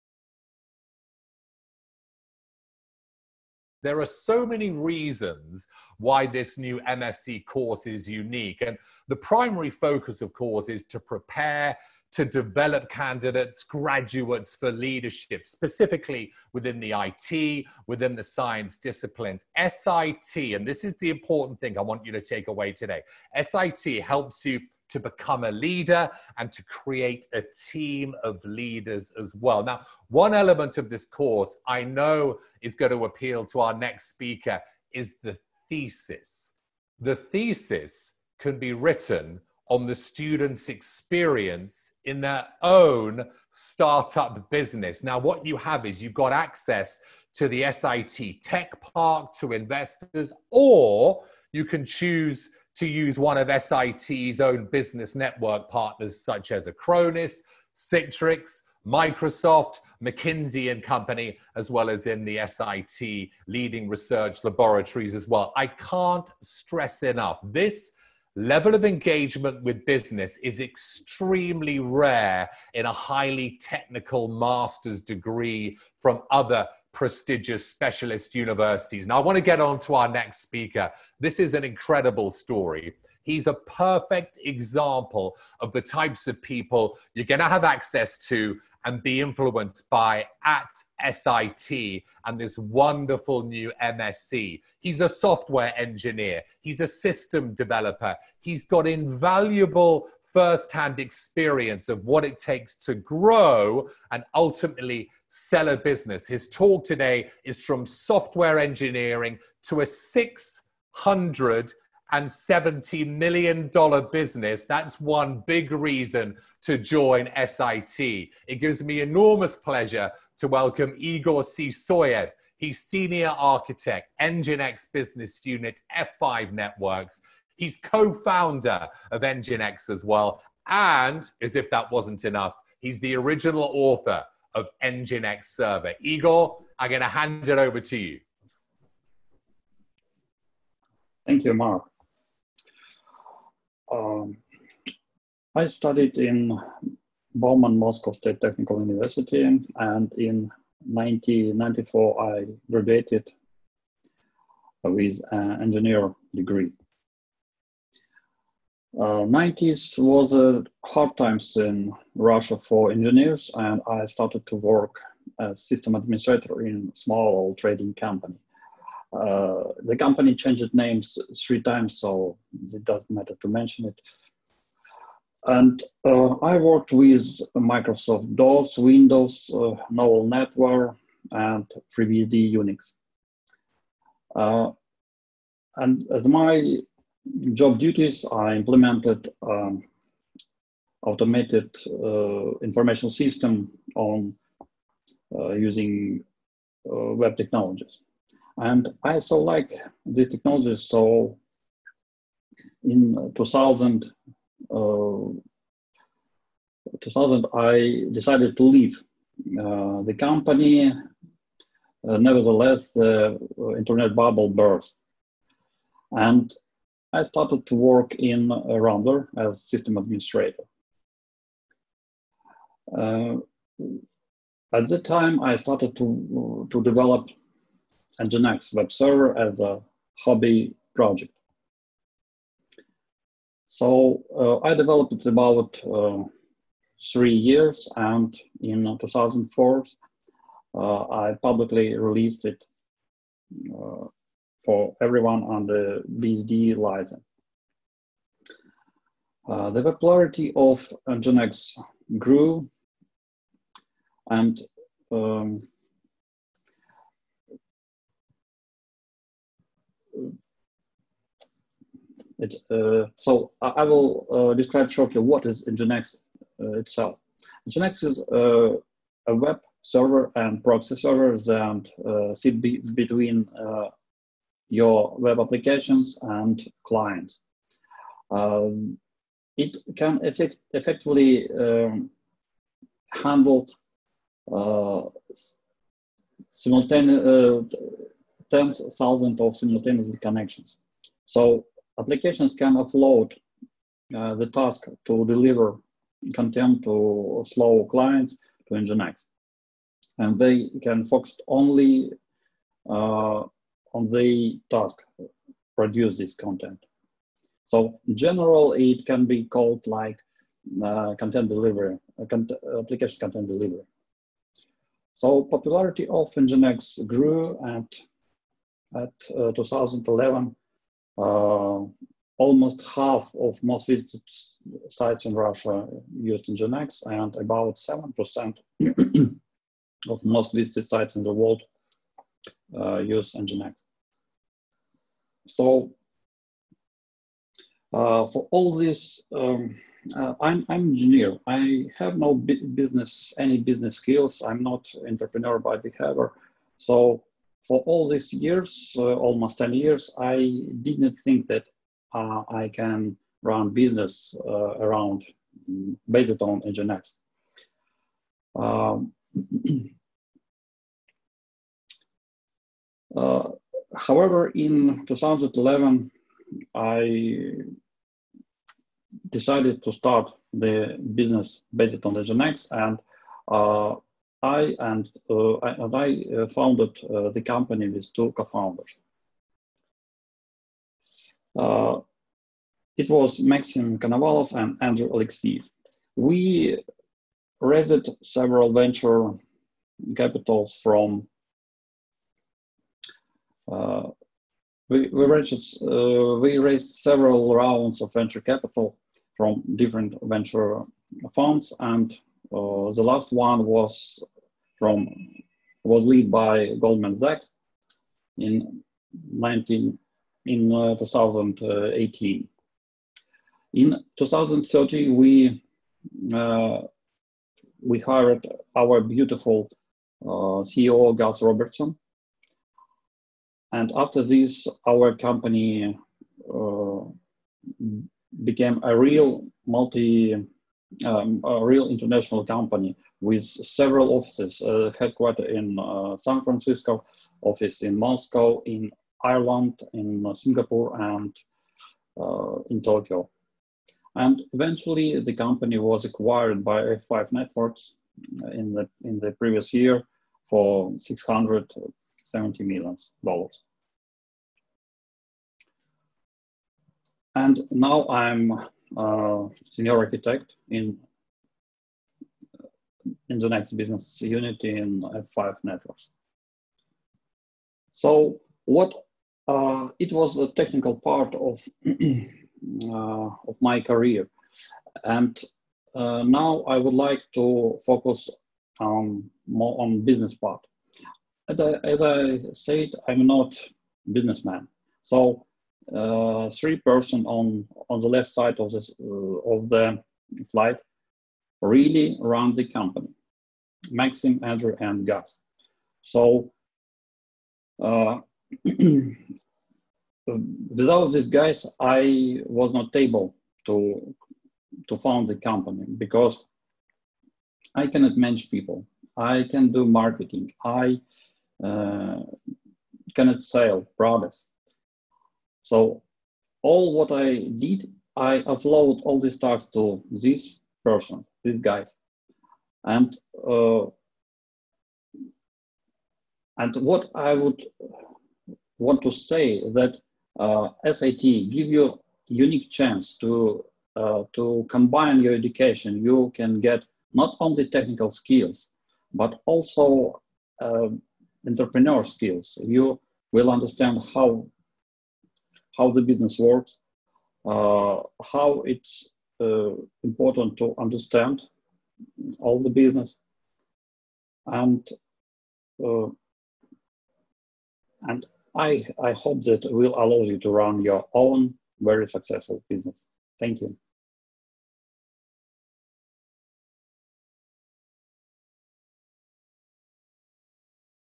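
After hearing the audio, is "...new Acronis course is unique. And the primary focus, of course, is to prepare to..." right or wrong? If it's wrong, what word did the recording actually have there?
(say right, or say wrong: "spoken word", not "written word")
wrong: "MSc", not "Acronis".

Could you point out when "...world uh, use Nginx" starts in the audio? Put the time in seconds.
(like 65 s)
331 s.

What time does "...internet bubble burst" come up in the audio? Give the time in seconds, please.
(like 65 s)
213 s.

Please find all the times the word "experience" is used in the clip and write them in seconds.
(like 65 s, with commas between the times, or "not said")
40 s, 100 s.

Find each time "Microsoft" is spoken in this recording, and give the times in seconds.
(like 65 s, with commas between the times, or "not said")
58 s, 177 s.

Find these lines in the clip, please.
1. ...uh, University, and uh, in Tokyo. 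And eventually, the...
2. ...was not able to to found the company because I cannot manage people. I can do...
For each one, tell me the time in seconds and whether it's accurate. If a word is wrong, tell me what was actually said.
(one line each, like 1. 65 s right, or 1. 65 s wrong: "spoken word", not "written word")
1. 440 s wrong: "Singapore", not "University"
2. 502 s right.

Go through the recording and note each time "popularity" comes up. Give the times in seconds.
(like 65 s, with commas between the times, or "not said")
249 s, 315 s.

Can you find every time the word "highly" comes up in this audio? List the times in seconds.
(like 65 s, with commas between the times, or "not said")
72 s.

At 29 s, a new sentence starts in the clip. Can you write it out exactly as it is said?
Now, one element of this course I know is going to appeal to our next speaker is the thesis.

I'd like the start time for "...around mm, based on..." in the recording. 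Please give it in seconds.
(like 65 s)
354 s.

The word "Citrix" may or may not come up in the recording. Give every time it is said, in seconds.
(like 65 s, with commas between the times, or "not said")
57 s.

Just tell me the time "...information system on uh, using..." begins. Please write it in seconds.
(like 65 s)
192 s.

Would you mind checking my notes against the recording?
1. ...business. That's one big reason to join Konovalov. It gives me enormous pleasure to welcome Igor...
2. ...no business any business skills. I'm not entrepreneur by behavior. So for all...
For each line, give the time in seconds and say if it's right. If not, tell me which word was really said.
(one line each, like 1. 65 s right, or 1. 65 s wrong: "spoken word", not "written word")
1. 114 s wrong: "SIT", not "Konovalov"
2. 342 s right.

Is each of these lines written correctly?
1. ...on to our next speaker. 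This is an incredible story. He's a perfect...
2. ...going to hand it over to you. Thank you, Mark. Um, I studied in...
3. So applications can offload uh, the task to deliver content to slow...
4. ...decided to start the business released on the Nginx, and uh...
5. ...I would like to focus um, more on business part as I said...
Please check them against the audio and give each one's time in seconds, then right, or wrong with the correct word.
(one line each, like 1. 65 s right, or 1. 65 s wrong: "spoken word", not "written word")
1. 79 s right
2. 136 s right
3. 291 s right
4. 369 s wrong: "based", not "released"
5. 476 s right.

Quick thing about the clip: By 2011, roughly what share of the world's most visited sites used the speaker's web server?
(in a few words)
7%.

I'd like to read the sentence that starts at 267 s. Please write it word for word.
Nginx is uh, a web server and proxy server that sit be between your web applications and clients.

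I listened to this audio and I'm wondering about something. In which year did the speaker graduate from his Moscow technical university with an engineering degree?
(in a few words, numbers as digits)
1994.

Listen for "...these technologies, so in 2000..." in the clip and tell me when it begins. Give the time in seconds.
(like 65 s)
200 s.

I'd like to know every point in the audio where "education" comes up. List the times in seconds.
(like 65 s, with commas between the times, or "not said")
535 s.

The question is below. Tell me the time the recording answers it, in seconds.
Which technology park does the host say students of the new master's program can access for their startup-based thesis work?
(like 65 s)
47 s.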